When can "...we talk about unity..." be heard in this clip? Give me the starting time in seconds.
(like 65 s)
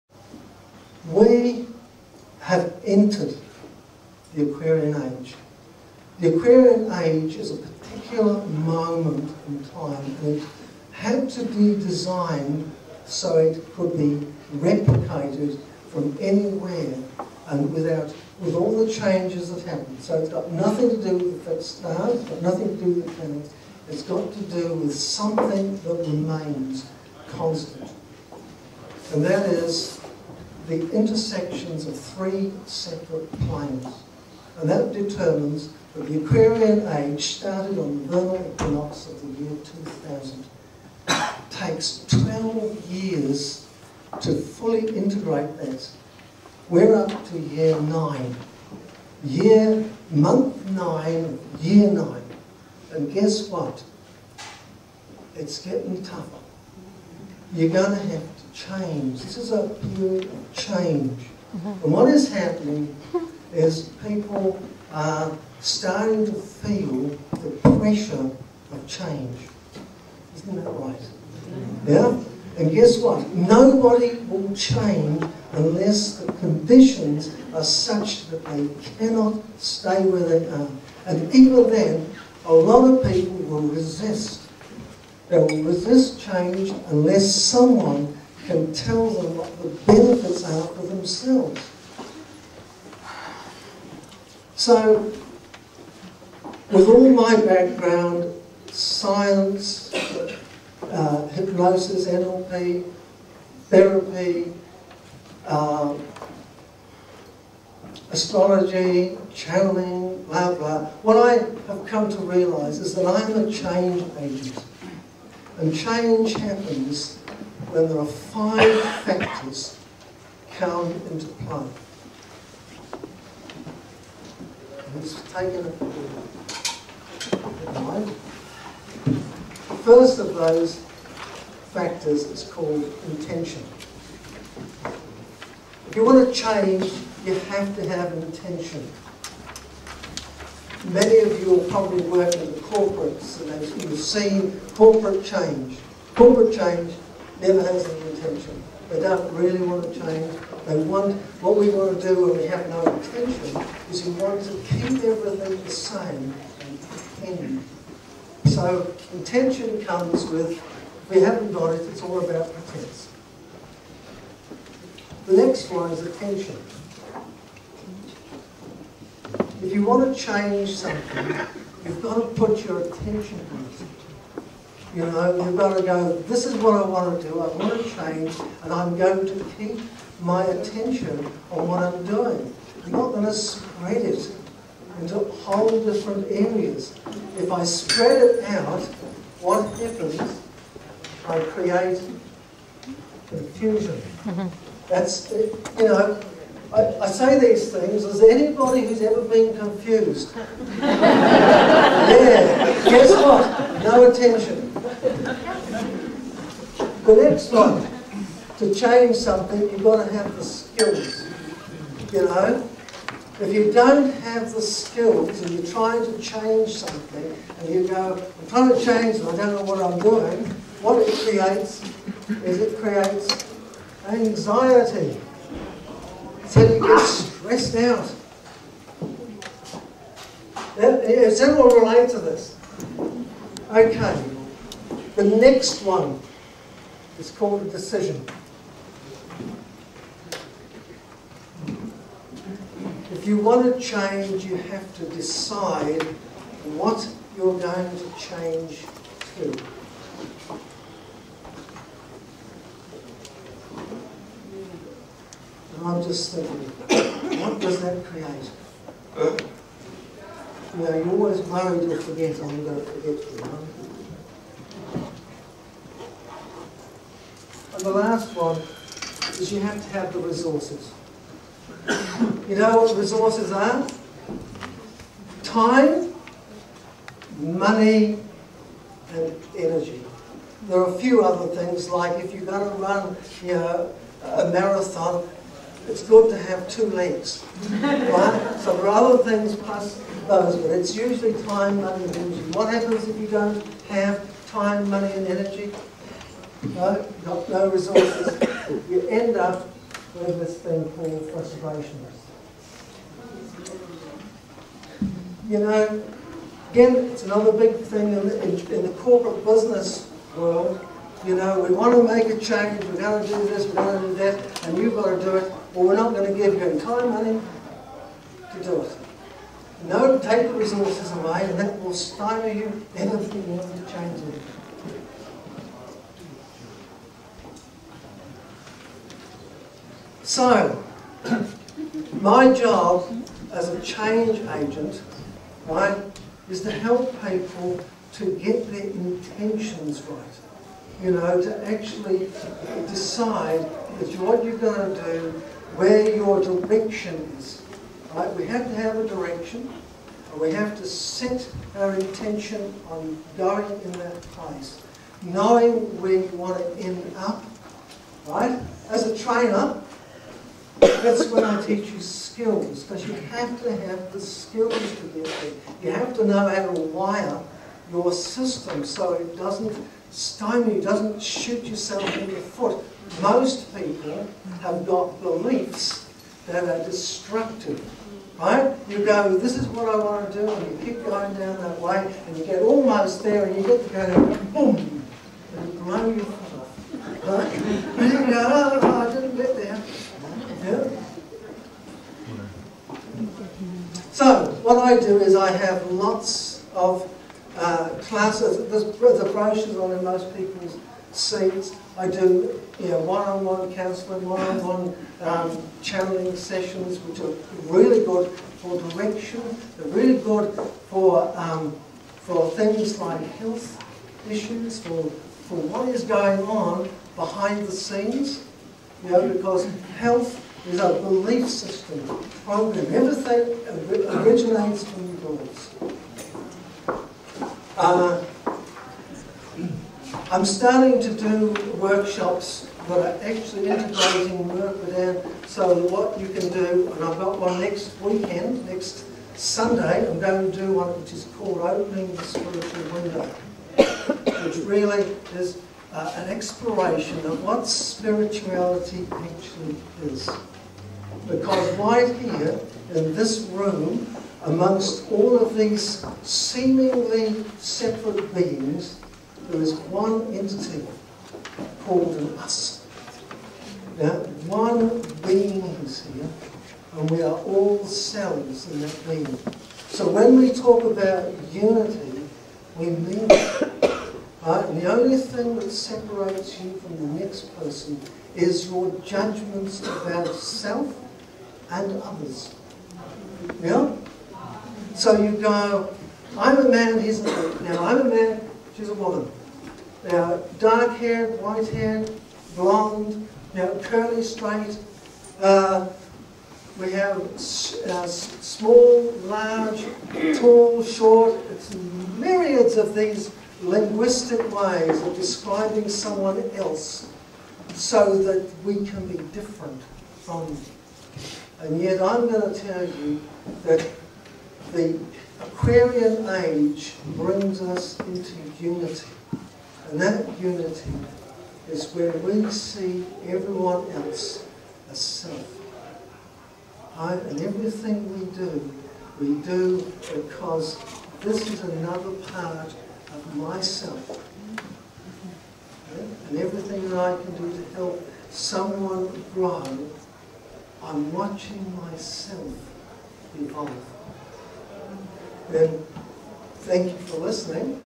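470 s.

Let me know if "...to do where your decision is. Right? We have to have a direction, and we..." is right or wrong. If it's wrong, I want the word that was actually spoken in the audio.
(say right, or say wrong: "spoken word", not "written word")
wrong: "direction", not "decision".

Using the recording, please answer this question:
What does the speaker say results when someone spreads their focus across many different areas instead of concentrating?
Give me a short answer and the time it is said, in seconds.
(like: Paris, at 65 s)
confusion, at 193 s.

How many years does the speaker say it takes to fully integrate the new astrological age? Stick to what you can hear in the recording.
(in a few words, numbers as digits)
12.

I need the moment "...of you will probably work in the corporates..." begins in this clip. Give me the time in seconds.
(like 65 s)
141 s.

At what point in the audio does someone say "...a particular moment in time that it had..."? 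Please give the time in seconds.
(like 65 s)
7 s.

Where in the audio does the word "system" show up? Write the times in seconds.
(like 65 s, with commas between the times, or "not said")
368 s, 421 s.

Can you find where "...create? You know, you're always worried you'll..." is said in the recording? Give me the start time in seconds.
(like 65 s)
258 s.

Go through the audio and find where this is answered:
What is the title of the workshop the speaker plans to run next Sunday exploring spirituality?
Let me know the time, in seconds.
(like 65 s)
441 s.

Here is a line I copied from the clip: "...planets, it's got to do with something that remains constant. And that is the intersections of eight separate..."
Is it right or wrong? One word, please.
wrong.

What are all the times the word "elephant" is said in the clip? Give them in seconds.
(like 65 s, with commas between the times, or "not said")
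not said.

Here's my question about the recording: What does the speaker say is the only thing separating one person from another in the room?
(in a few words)
judgments about self and others.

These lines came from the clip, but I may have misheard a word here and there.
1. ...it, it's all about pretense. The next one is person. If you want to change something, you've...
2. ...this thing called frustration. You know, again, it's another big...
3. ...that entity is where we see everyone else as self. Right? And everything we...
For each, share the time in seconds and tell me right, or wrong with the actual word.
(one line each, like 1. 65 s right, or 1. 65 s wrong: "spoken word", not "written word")
1. 161 s wrong: "attention", not "person"
2. 300 s right
3. 520 s wrong: "unity", not "entity".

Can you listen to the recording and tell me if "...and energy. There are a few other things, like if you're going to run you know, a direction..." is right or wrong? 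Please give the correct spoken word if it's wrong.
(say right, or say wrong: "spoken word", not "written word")
wrong: "marathon", not "direction".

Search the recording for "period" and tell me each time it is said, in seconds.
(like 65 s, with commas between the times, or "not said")
59 s.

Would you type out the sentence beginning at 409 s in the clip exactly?
They're really good for um, for things like health issues, for for what is going on behind the scenes.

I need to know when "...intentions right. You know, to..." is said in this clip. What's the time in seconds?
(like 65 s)
338 s.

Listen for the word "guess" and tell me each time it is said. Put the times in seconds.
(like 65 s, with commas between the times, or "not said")
53 s, 72 s, 202 s.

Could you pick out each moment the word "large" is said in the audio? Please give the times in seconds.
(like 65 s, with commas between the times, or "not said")
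499 s.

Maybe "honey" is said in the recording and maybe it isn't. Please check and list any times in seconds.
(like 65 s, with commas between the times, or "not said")
317 s.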